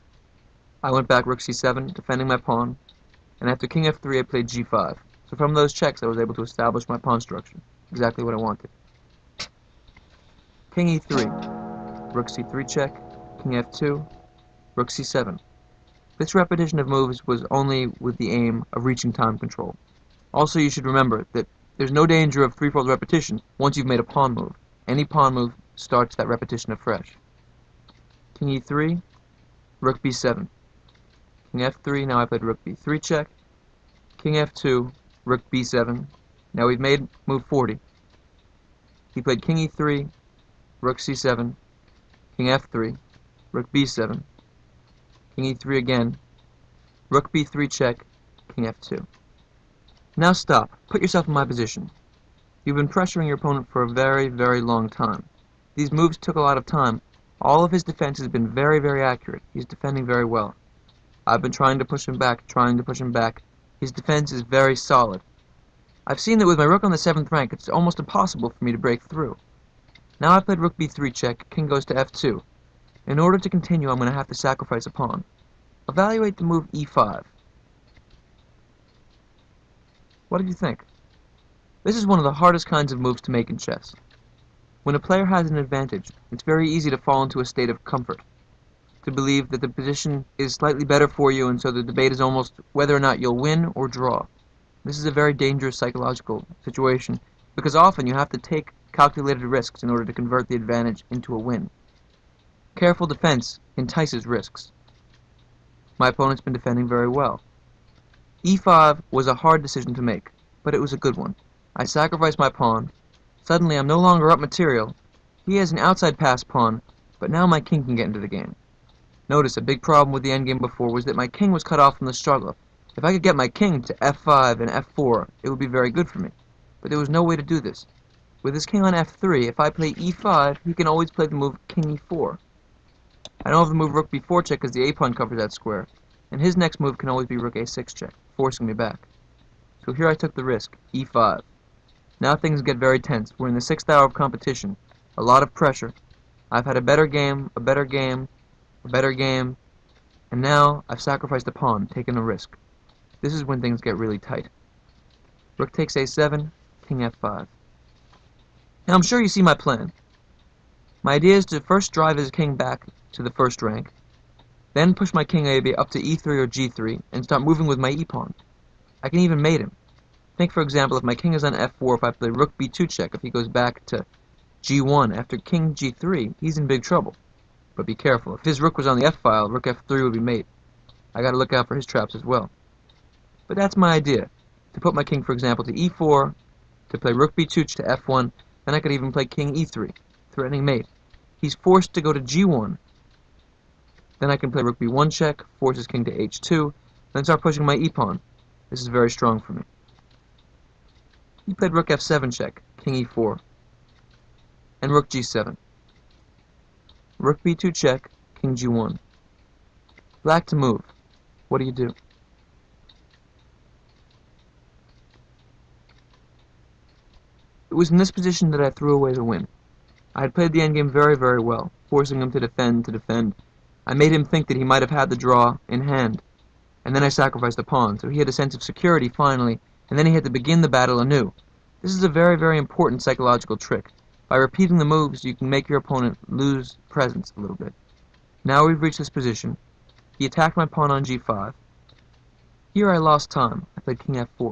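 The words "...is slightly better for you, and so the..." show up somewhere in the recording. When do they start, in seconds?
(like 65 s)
90 s.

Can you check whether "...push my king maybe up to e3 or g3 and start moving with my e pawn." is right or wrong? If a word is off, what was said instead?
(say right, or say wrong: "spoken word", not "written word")
right.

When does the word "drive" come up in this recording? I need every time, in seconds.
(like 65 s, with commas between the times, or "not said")
161 s.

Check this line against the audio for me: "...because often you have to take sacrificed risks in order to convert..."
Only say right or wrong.
wrong.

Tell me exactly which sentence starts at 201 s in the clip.
He played rook f7 check, king e4, and rook g7.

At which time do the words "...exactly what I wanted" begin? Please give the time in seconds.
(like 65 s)
7 s.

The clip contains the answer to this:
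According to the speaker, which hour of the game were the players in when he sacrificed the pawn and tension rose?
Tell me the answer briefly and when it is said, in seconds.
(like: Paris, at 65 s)
sixth hour, at 143 s.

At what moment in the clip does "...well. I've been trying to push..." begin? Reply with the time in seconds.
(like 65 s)
60 s.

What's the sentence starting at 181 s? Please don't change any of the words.
I gotta look out for his traps as well.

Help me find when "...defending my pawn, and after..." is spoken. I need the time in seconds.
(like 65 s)
1 s.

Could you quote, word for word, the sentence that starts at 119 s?
Notice a big problem with the endgame before was that my king was cut off from the struggle.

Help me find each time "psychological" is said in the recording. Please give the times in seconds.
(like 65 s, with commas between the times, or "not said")
95 s, 233 s.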